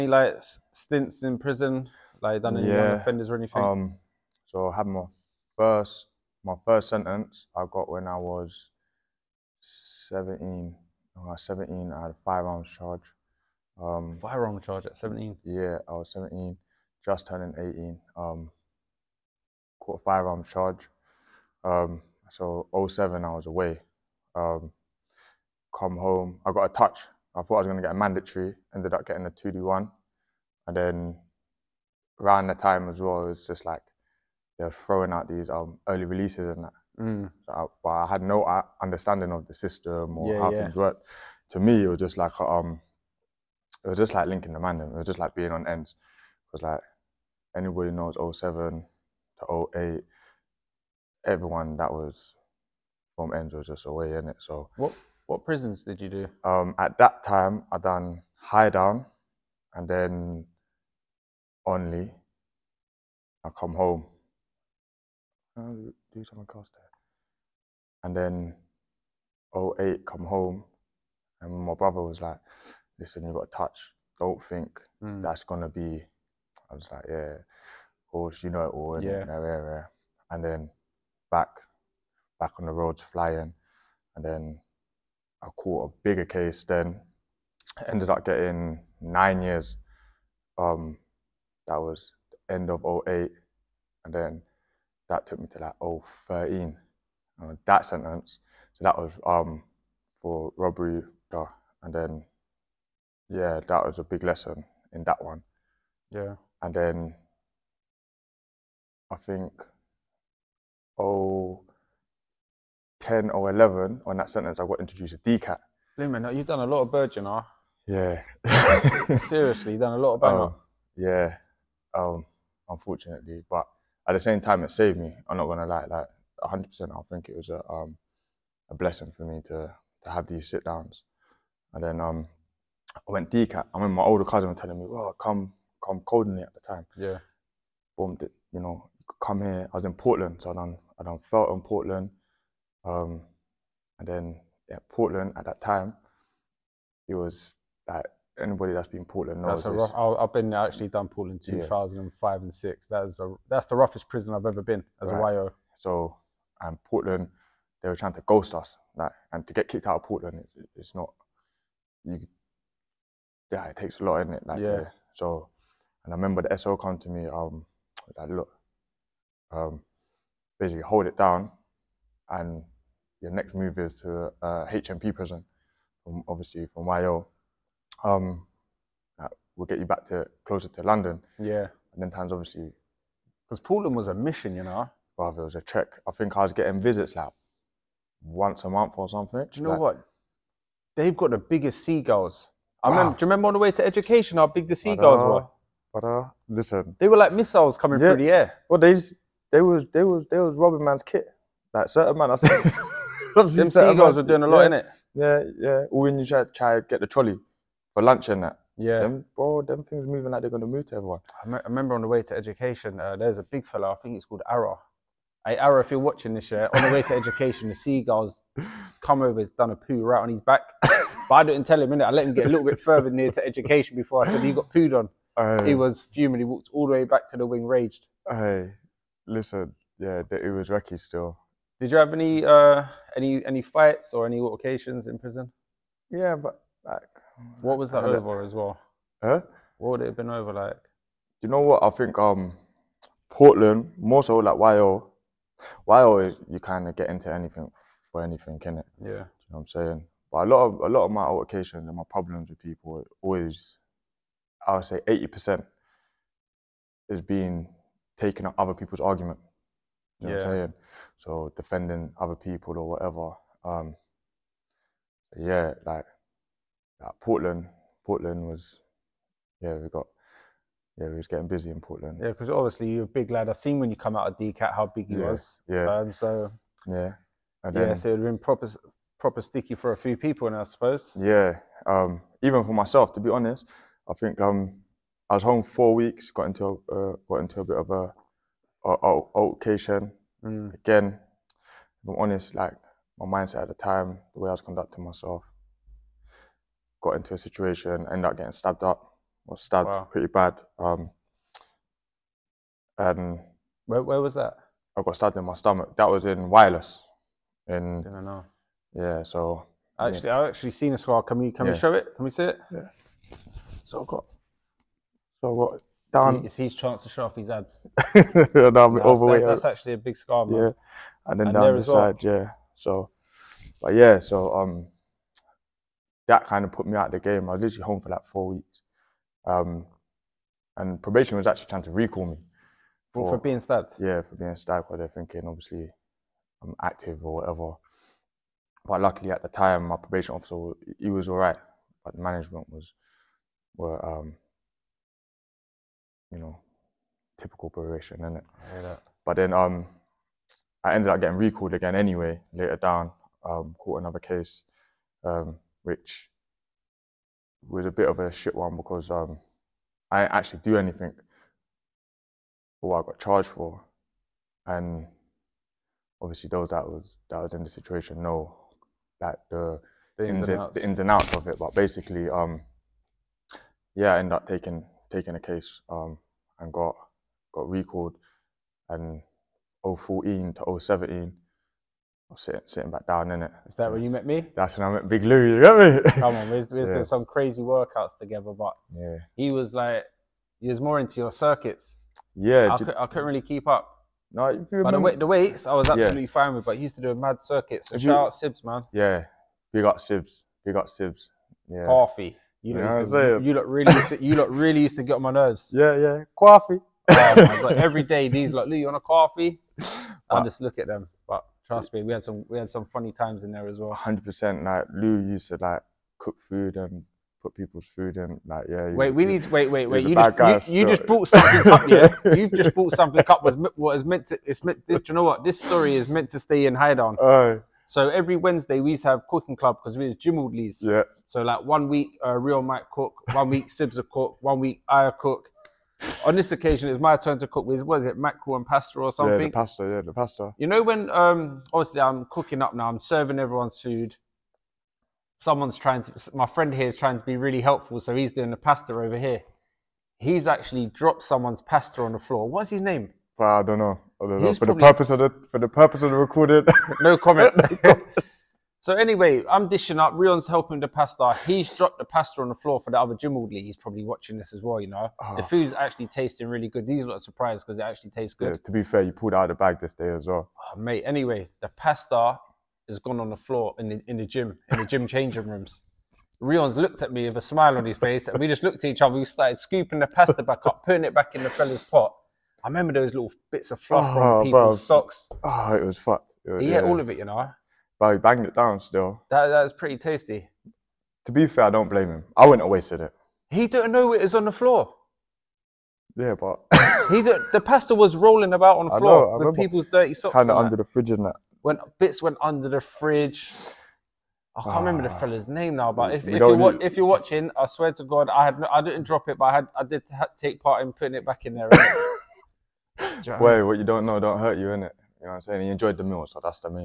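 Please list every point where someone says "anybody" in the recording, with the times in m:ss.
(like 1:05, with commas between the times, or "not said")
0:47, 2:28.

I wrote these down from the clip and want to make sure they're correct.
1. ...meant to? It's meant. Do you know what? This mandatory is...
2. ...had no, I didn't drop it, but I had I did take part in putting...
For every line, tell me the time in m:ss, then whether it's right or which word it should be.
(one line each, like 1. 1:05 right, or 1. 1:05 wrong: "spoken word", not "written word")
1. 7:04 wrong: "story", not "mandatory"
2. 8:28 right.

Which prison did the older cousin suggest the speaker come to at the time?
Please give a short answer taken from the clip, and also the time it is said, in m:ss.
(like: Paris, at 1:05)
Coldingley, at 2:15.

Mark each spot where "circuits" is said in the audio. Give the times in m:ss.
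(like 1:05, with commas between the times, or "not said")
6:31, 6:37.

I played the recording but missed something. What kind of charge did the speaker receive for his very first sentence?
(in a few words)
Firearms charge.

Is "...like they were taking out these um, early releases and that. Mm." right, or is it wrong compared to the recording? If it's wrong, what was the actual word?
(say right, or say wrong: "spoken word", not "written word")
wrong: "throwing", not "taking".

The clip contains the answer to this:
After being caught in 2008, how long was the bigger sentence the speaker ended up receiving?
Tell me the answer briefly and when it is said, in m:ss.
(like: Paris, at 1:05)
Nine years, at 1:29.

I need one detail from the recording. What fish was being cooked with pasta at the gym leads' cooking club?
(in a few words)
Mackerel.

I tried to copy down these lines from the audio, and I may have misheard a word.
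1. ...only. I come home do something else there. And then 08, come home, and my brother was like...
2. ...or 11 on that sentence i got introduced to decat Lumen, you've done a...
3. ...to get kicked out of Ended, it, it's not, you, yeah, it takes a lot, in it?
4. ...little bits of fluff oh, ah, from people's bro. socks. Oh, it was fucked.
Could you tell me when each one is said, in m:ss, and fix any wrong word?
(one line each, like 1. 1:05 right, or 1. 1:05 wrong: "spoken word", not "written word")
1. 1:01 right
2. 1:53 right
3. 2:39 wrong: "Portland", not "Ended"
4. 8:03 right.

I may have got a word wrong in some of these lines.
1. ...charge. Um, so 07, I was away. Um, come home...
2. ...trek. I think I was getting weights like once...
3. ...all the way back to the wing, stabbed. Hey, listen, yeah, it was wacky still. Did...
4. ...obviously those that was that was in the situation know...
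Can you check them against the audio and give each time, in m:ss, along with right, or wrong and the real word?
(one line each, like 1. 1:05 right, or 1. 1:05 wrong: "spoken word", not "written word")
1. 0:20 right
2. 3:05 wrong: "visits", not "weights"
3. 3:46 wrong: "raged", not "stabbed"
4. 6:06 right.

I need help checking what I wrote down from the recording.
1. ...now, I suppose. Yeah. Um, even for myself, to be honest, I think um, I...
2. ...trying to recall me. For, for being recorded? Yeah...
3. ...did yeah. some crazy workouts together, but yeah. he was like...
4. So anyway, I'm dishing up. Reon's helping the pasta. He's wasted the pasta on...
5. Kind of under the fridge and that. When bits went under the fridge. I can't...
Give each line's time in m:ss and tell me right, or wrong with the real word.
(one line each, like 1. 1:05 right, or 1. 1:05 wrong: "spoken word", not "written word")
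1. 4:40 right
2. 5:31 wrong: "stabbed", not "recorded"
3. 6:26 right
4. 7:38 wrong: "dropped", not "wasted"
5. 8:20 right.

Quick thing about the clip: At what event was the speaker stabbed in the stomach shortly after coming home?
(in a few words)
Wireless.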